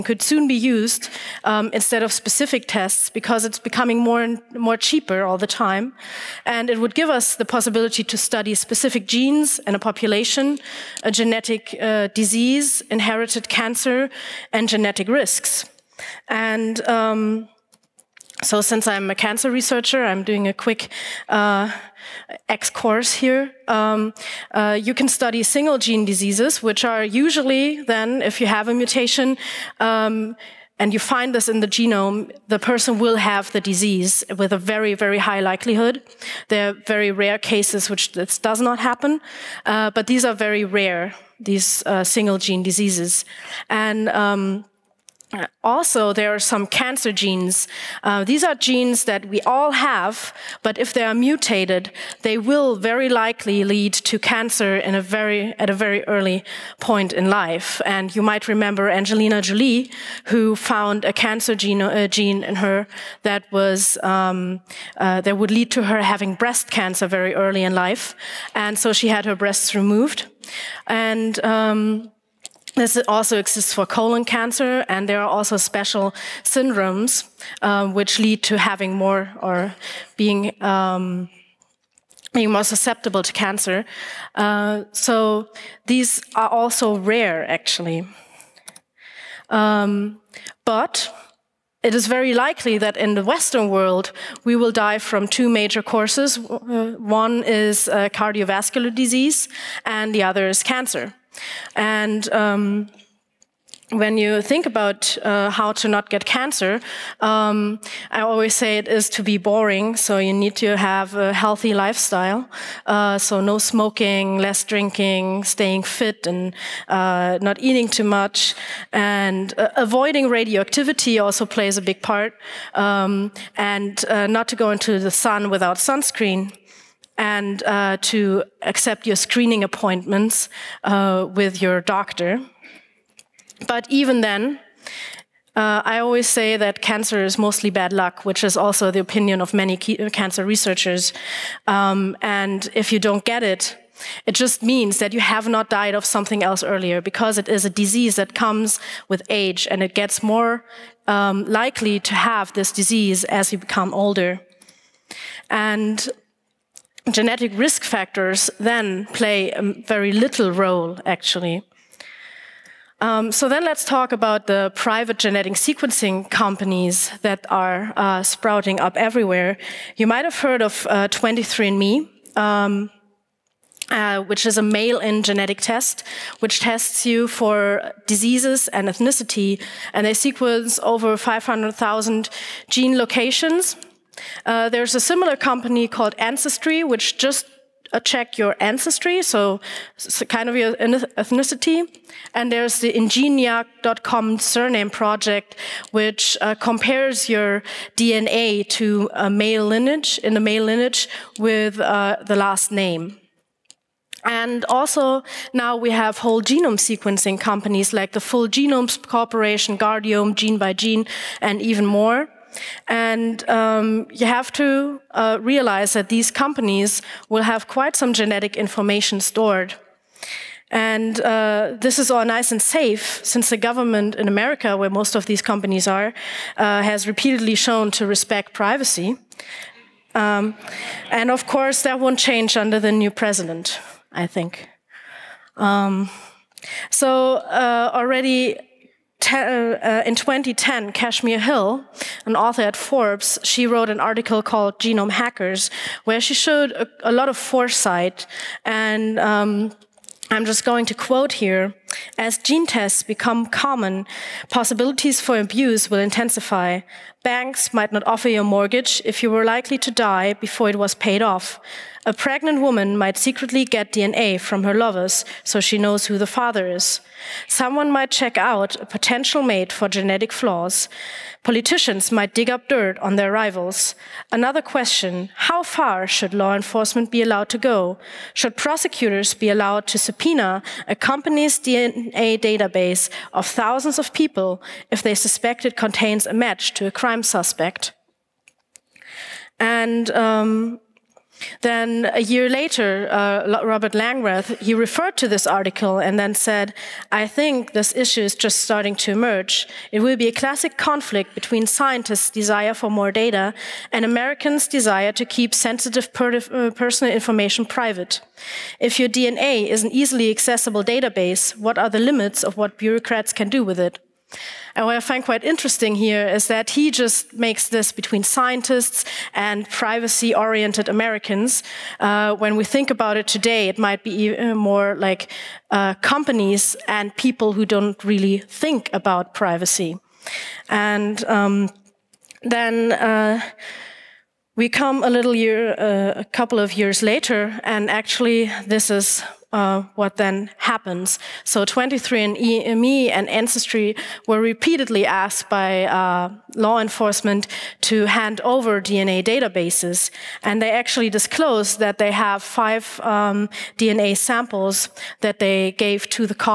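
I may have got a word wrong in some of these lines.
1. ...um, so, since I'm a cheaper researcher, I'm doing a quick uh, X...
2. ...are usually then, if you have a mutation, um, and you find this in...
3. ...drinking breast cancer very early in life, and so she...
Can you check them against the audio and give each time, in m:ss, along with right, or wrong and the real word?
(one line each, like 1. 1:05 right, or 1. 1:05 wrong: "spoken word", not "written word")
1. 0:16 wrong: "cancer", not "cheaper"
2. 0:26 right
3. 1:06 wrong: "having", not "drinking".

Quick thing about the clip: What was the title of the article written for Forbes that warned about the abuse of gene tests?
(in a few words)
Genome Hackers.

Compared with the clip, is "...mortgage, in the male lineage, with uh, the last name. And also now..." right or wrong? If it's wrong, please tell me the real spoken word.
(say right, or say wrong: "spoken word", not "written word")
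wrong: "lineage", not "mortgage".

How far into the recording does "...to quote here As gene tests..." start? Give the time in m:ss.
4:10.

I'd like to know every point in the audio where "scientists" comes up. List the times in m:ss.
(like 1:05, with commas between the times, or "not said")
5:01, 5:18.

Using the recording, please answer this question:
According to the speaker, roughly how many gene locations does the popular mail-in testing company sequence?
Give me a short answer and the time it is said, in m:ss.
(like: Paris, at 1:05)
500,000, at 3:01.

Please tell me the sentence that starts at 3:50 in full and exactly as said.
Um, and of course, that won't change under the new president, I think.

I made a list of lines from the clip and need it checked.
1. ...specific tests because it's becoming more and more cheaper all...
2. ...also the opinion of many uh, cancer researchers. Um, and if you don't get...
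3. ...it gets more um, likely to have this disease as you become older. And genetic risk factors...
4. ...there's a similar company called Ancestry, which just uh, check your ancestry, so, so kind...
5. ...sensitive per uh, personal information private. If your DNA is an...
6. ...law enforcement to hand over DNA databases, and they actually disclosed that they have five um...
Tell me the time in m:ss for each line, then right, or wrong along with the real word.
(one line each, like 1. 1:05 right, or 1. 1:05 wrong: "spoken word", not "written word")
1. 0:02 right
2. 2:18 right
3. 2:29 right
4. 3:04 right
5. 5:05 right
6. 5:46 right.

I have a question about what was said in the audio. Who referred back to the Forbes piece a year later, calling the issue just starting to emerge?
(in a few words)
Robert Langreth.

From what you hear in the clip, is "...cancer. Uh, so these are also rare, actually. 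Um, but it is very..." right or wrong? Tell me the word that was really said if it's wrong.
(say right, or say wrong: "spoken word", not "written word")
right.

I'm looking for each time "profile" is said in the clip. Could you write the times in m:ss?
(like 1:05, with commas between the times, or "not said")
not said.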